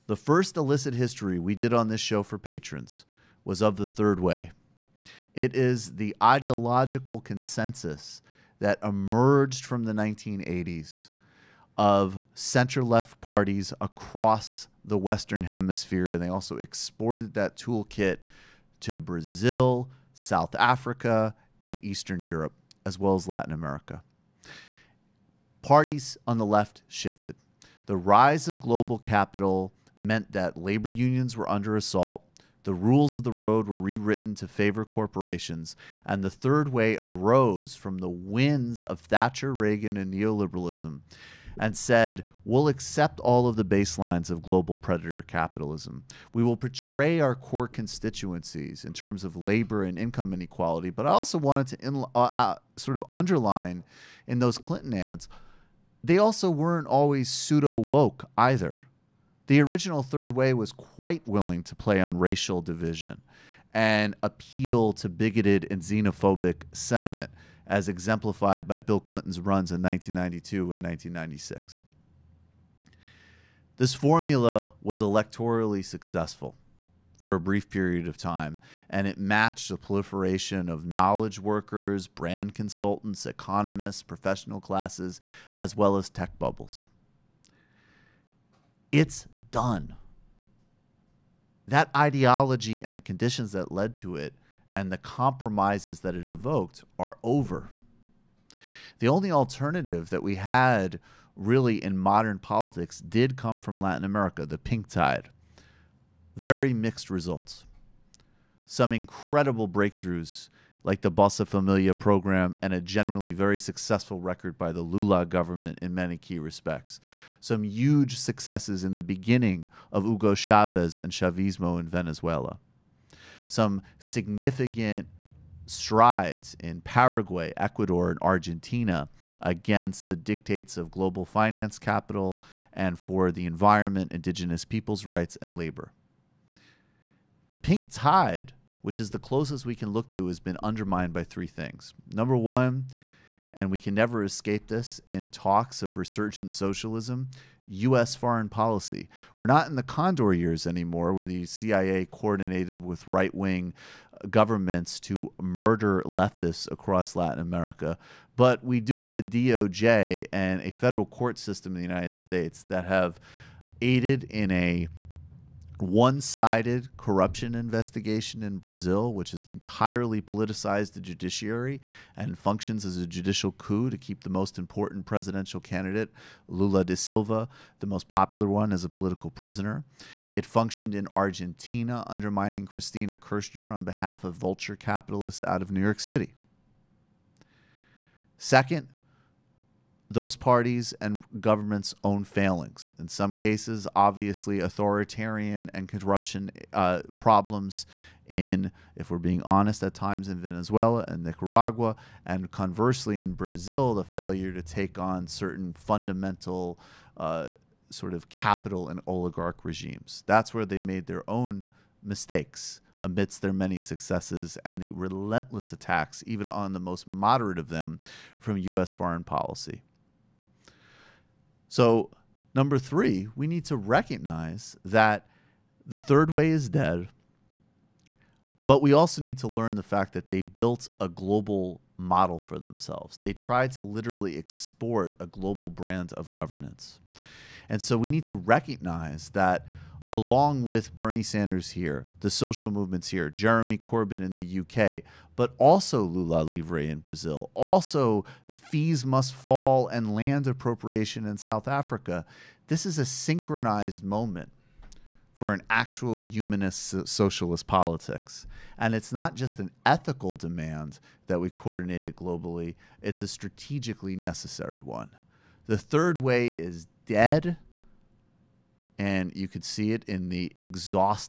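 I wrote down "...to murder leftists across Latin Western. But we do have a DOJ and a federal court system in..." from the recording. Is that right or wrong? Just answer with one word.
wrong.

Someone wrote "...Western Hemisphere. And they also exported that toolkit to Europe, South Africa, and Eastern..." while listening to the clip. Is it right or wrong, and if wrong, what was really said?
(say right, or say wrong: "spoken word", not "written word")
wrong: "Brazil", not "Europe".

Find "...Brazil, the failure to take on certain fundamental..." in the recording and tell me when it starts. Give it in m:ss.
3:23.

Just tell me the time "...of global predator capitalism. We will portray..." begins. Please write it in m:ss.
0:44.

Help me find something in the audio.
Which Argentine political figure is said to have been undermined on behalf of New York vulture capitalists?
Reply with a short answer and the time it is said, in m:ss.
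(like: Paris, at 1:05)
Cristina Kirchner, at 3:02.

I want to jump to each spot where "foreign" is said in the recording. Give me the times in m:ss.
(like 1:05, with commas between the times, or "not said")
2:28, 3:38.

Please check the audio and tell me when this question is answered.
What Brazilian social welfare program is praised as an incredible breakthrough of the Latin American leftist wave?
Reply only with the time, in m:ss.
1:51.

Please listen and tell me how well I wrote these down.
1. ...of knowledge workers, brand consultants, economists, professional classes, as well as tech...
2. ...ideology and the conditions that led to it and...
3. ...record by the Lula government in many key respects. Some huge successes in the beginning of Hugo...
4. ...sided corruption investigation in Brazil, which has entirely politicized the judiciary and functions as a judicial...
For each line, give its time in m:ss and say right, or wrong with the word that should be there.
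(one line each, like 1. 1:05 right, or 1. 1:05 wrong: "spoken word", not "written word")
1. 1:20 right
2. 1:31 right
3. 1:54 right
4. 2:46 right.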